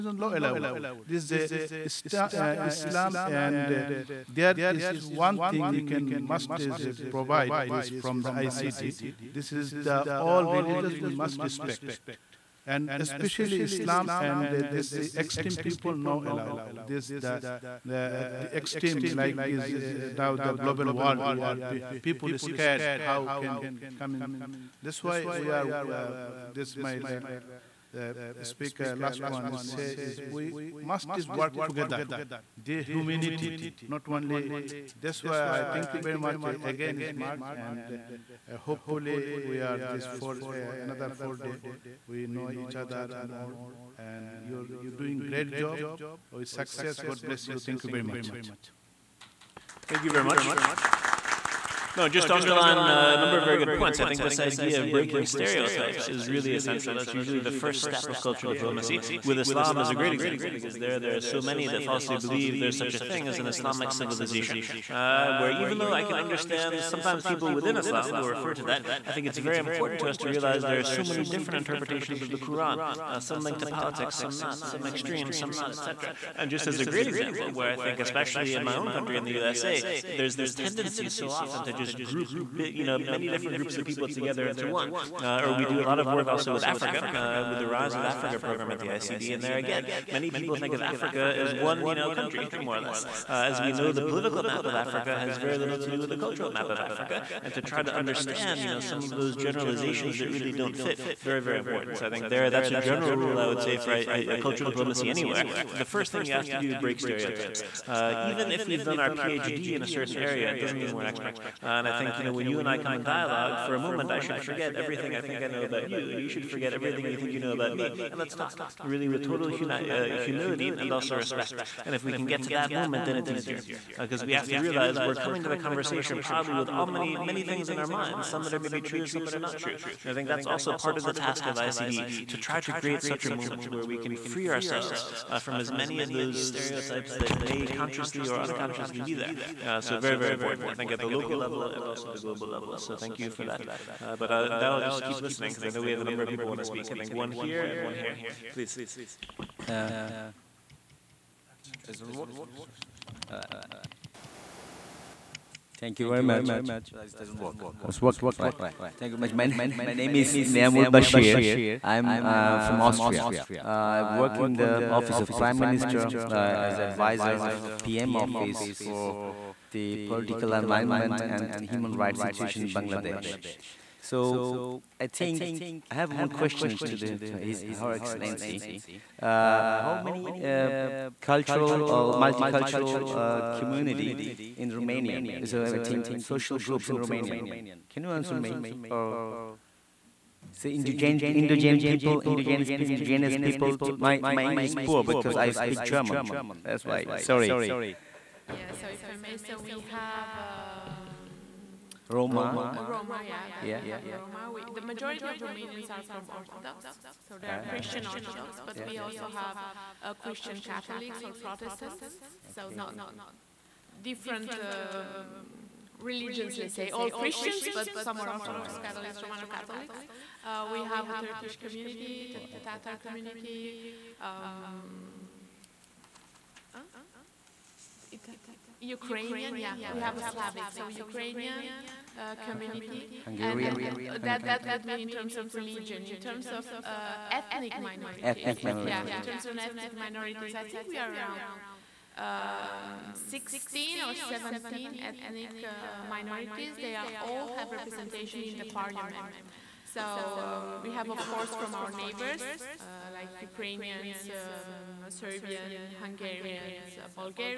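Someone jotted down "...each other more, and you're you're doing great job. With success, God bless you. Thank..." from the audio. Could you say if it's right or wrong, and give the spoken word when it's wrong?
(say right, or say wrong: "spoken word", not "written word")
right.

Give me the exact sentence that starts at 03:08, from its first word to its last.
Or so indigenous, indigenous people, indigenous, indigenous people.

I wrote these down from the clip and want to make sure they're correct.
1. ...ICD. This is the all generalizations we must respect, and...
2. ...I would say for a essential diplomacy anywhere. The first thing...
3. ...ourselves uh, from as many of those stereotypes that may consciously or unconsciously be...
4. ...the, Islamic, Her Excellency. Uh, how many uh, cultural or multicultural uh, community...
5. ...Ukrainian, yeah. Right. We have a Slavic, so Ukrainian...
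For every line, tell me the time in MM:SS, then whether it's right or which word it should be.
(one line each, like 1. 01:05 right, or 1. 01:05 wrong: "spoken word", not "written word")
1. 00:08 wrong: "religions", not "generalizations"
2. 01:43 wrong: "cultural", not "essential"
3. 02:14 right
4. 02:57 wrong: "His", not "Islamic"
5. 03:48 right.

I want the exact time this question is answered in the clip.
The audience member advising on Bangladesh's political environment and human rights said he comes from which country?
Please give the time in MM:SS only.
02:42.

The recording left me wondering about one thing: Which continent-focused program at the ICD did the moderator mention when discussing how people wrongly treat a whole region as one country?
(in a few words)
Rise of Africa.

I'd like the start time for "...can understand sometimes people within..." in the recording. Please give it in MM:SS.
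01:06.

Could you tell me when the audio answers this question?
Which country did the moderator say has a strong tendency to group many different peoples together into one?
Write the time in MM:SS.
01:19.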